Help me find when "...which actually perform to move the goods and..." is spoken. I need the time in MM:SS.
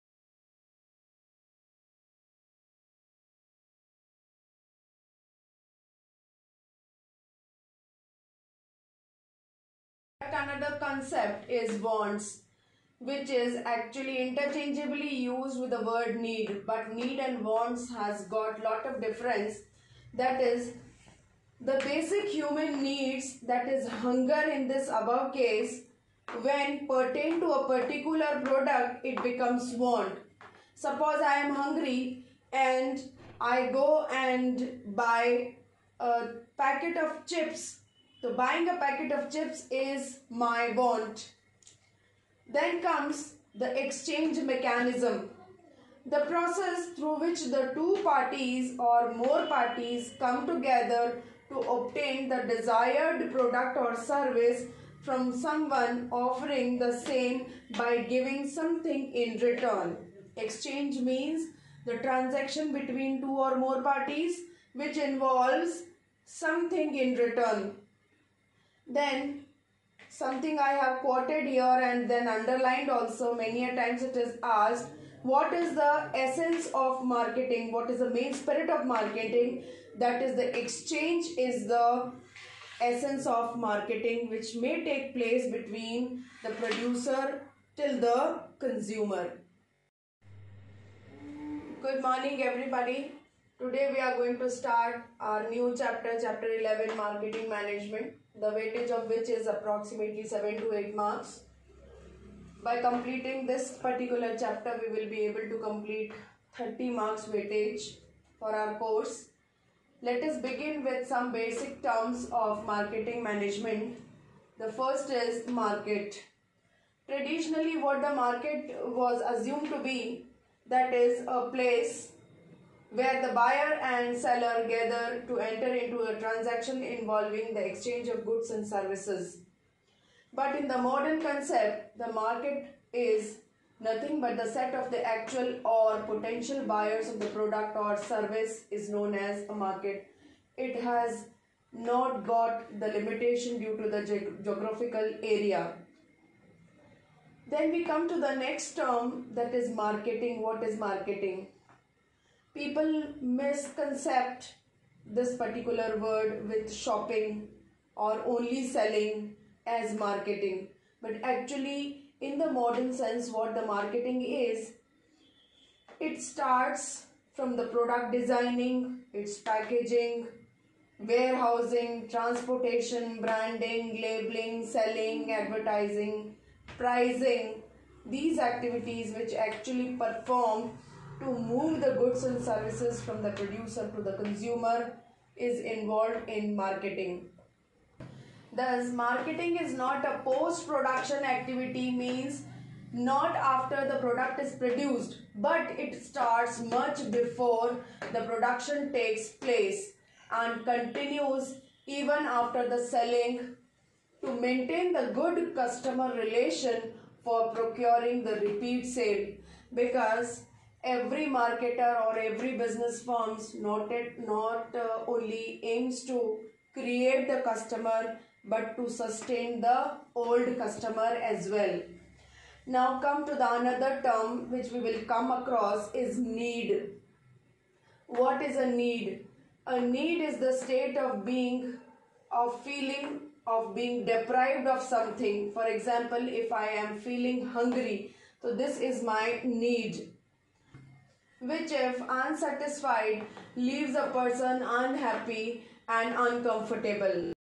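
02:59.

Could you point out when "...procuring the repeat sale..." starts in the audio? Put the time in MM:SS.
03:27.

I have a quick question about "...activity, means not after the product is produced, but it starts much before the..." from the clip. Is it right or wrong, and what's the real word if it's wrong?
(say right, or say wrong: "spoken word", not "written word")
right.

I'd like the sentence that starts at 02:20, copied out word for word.
It has not got the limitation due to the ge- geographical area.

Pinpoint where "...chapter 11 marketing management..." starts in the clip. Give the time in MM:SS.
01:36.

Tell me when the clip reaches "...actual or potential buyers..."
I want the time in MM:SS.
02:15.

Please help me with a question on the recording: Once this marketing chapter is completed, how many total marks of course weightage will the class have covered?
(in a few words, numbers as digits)
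30.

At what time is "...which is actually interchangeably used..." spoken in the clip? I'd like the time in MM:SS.
00:12.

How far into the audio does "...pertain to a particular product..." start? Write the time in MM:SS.
00:26.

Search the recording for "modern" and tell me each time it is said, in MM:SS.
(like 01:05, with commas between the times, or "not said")
02:10, 02:42.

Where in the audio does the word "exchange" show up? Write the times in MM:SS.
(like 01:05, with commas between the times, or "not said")
00:43, 01:00, 01:20, 02:07.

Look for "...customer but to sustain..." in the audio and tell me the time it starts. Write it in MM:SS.
03:37.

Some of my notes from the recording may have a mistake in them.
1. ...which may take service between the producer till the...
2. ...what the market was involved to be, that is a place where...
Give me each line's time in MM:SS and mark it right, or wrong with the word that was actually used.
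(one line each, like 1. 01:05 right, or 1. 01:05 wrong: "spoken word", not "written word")
1. 01:24 wrong: "place", not "service"
2. 01:57 wrong: "assumed", not "involved".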